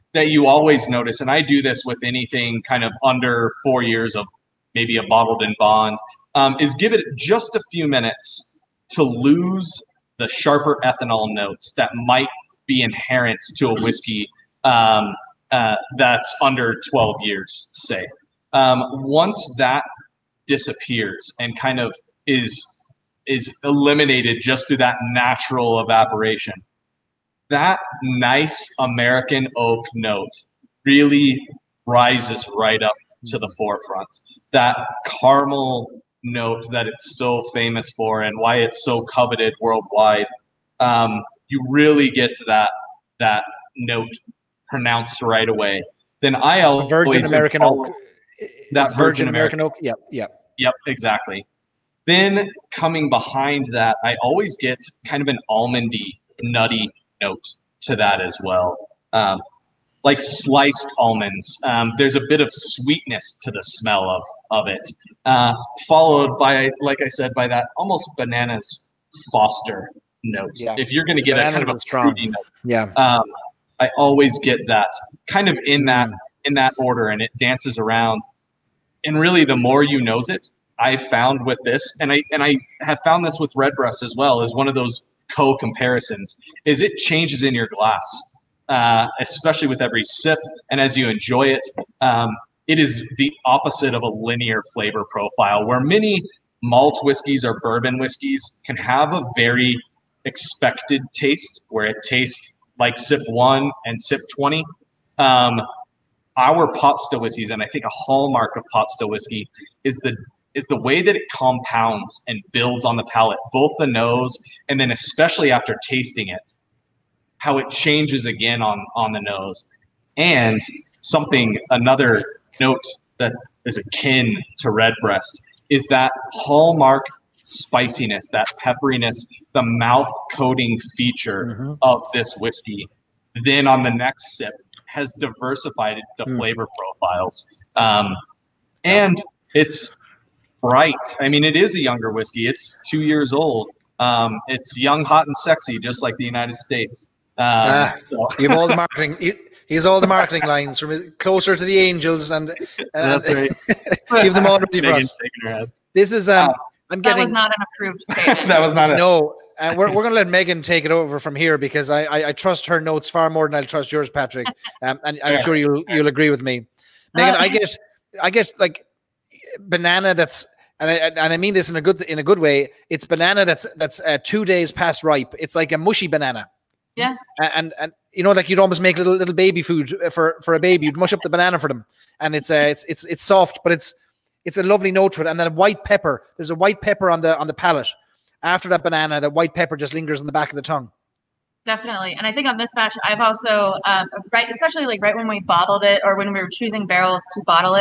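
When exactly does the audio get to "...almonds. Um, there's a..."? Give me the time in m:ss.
1:00.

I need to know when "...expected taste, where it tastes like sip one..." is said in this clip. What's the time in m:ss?
1:40.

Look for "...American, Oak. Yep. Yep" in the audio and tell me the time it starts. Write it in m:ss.
0:49.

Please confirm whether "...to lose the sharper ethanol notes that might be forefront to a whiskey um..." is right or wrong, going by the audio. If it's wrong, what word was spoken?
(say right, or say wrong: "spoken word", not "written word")
wrong: "inherent", not "forefront".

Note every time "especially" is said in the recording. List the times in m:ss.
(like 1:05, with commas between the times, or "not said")
1:29, 1:54, 3:14.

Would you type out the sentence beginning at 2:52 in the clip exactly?
It's banana that's that's uh, two days past ripe.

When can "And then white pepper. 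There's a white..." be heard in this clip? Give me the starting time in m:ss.
3:05.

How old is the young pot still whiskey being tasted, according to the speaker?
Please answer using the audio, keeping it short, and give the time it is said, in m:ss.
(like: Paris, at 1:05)
2 years, at 2:22.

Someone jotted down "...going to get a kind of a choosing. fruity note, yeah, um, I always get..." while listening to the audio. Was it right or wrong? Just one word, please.
wrong.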